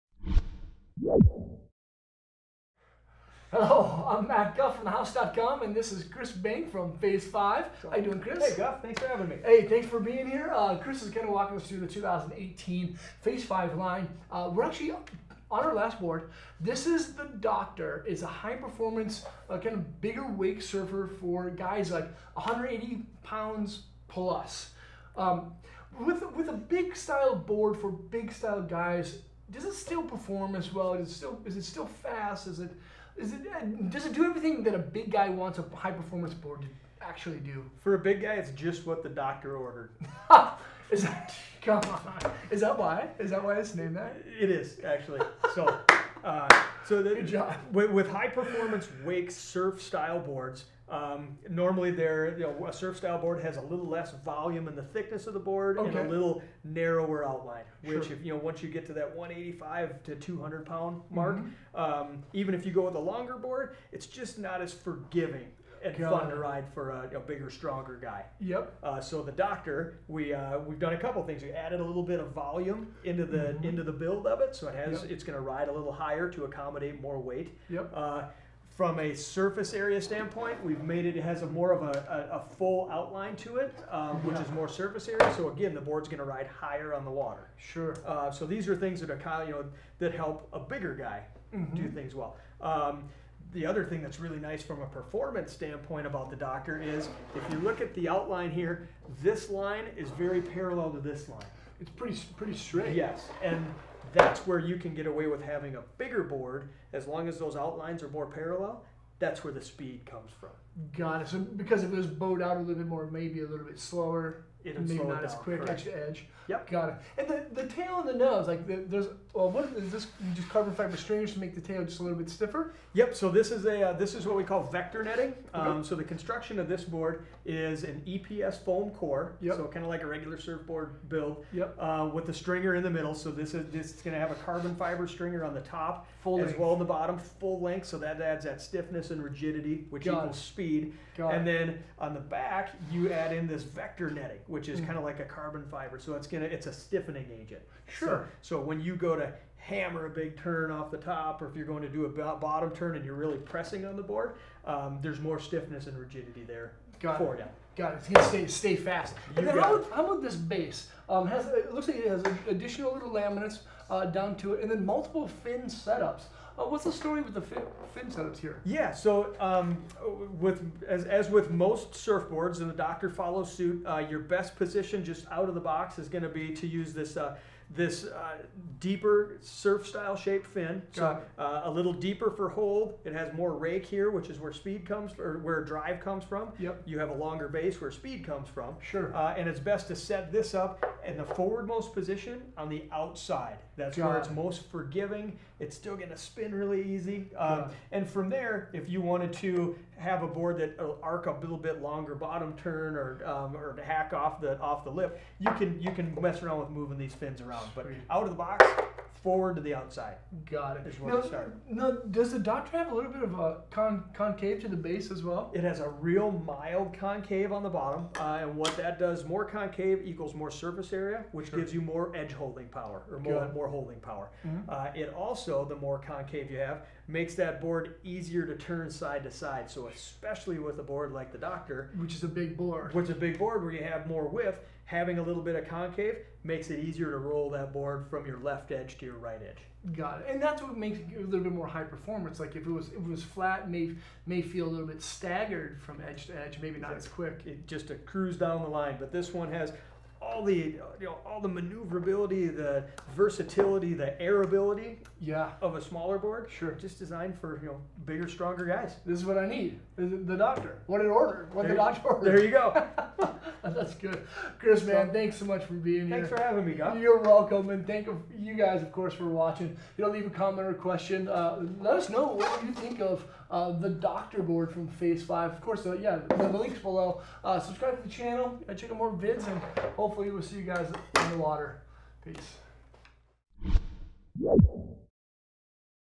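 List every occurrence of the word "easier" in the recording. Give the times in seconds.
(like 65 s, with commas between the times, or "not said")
228 s, 236 s.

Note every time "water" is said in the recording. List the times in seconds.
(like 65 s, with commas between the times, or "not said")
87 s, 281 s.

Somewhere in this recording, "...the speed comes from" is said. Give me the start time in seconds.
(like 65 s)
109 s.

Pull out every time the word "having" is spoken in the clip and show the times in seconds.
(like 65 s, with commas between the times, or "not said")
9 s, 105 s, 234 s, 266 s.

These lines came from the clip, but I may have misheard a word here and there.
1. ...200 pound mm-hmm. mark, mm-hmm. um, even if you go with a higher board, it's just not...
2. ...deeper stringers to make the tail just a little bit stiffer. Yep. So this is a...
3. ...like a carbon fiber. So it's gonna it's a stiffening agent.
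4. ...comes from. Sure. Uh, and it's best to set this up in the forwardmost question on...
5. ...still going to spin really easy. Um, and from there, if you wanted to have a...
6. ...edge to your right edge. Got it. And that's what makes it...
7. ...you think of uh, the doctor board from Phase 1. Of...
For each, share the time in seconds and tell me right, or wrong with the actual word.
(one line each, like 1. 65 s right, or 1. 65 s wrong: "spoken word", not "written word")
1. 60 s wrong: "longer", not "higher"
2. 120 s wrong: "fiber", not "deeper"
3. 145 s right
4. 188 s wrong: "position", not "question"
5. 195 s right
6. 238 s right
7. 272 s wrong: "5", not "1".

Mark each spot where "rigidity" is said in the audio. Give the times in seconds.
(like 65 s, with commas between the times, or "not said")
139 s, 155 s.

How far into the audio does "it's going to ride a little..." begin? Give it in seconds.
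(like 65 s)
75 s.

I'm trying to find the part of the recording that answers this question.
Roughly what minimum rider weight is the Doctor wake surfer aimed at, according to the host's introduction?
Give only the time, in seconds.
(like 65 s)
22 s.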